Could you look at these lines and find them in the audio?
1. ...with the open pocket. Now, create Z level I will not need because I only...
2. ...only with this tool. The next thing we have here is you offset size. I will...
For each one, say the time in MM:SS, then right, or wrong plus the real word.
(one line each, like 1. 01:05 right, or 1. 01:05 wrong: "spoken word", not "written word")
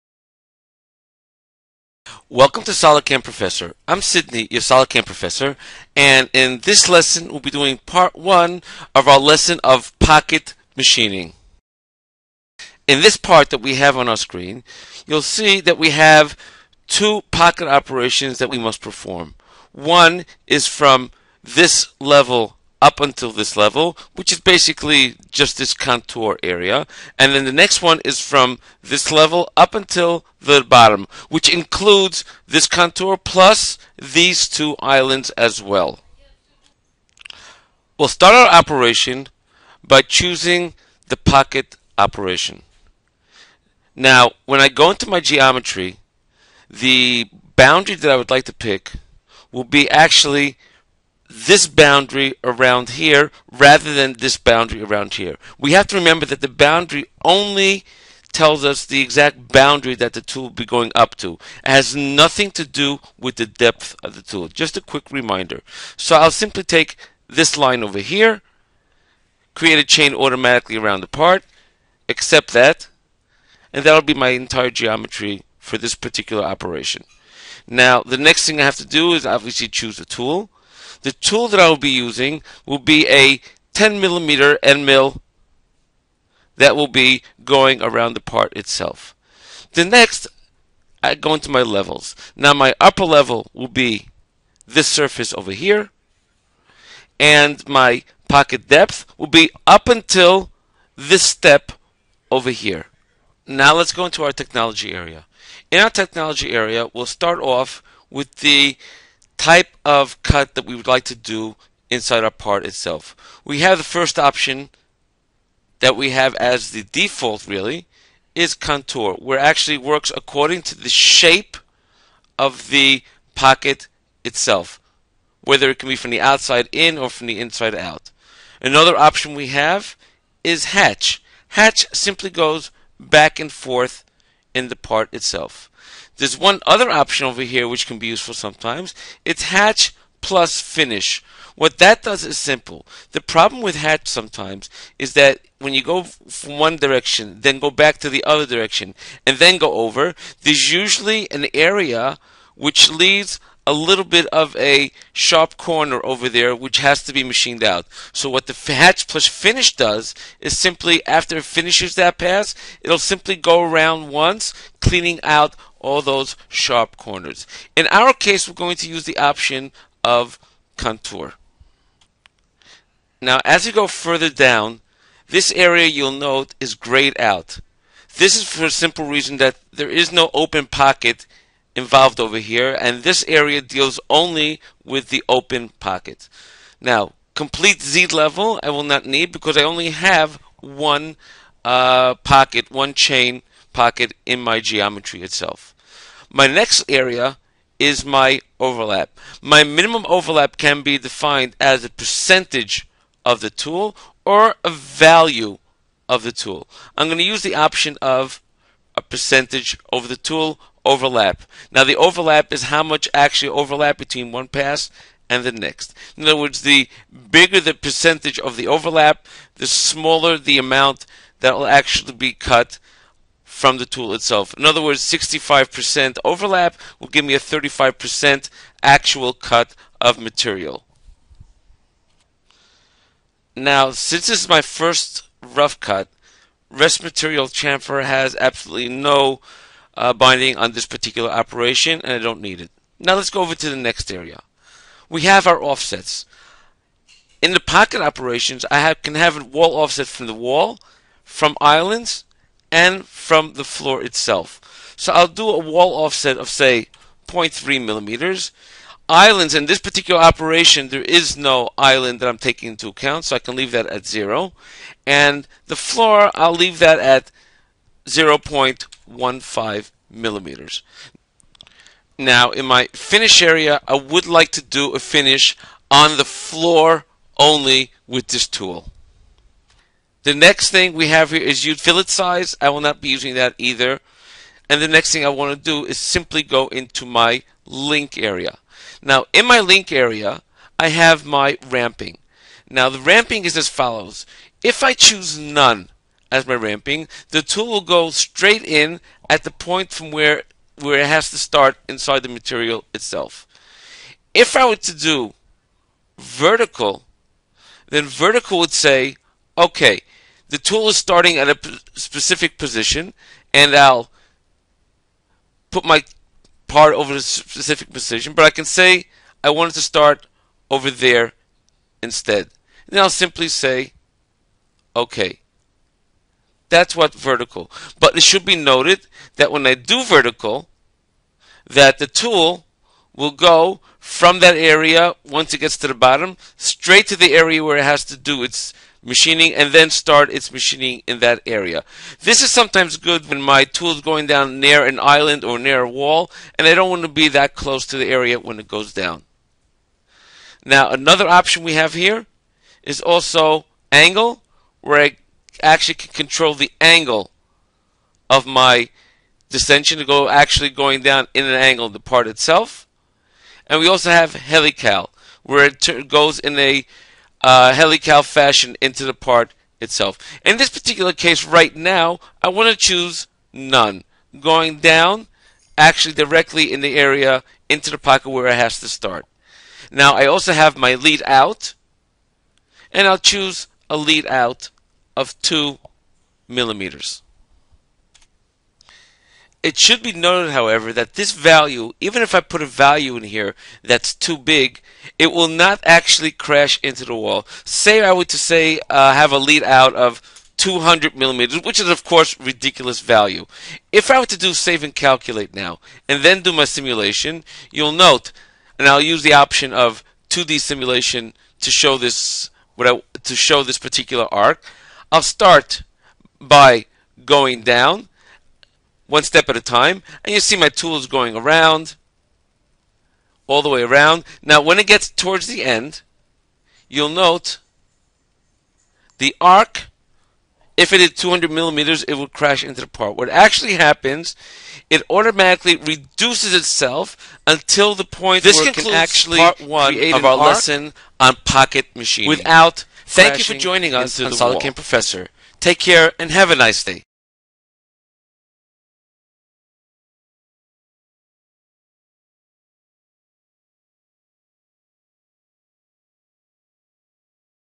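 1. 03:04 wrong: "complete", not "create"
2. 04:37 wrong: "fillet", not "offset".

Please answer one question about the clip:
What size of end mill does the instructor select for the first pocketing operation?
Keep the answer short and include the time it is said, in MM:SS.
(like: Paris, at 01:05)
10 millimeter, at 01:23.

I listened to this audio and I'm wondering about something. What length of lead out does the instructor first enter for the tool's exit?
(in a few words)
2 millimeters.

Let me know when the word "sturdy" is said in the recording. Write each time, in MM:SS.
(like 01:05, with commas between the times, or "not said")
not said.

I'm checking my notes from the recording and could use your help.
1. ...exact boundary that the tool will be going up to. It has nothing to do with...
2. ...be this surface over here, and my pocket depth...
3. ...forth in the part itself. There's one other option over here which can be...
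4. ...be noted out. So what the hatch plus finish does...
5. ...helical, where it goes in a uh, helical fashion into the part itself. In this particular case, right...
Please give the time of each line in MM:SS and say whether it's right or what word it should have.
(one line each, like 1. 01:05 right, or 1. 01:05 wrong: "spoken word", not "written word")
1. 00:59 right
2. 01:33 right
3. 02:13 right
4. 02:37 wrong: "machined", not "noted"
5. 06:04 right.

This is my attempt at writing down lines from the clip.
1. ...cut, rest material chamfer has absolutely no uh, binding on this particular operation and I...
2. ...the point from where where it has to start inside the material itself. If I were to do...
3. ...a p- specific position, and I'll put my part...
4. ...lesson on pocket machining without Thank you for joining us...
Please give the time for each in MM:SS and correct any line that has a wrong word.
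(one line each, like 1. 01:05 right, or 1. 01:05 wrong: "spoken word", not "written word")
1. 03:55 right
2. 04:59 right
3. 05:11 right
4. 07:20 right.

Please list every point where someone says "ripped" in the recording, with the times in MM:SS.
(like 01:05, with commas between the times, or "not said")
not said.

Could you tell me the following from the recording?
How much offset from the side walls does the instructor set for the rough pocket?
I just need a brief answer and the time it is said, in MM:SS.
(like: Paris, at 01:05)
0.3 millimeters, at 04:17.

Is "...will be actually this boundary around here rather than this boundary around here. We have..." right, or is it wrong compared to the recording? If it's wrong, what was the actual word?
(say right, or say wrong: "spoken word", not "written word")
right.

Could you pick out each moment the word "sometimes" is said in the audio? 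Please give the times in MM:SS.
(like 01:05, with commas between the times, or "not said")
02:18, 02:24, 05:42.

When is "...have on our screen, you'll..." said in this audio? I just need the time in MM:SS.
00:13.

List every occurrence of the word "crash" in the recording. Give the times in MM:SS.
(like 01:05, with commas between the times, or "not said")
06:36, 07:12.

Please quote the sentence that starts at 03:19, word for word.
My minimum overlap can be defined as a percentage of the tool or a value of the tool.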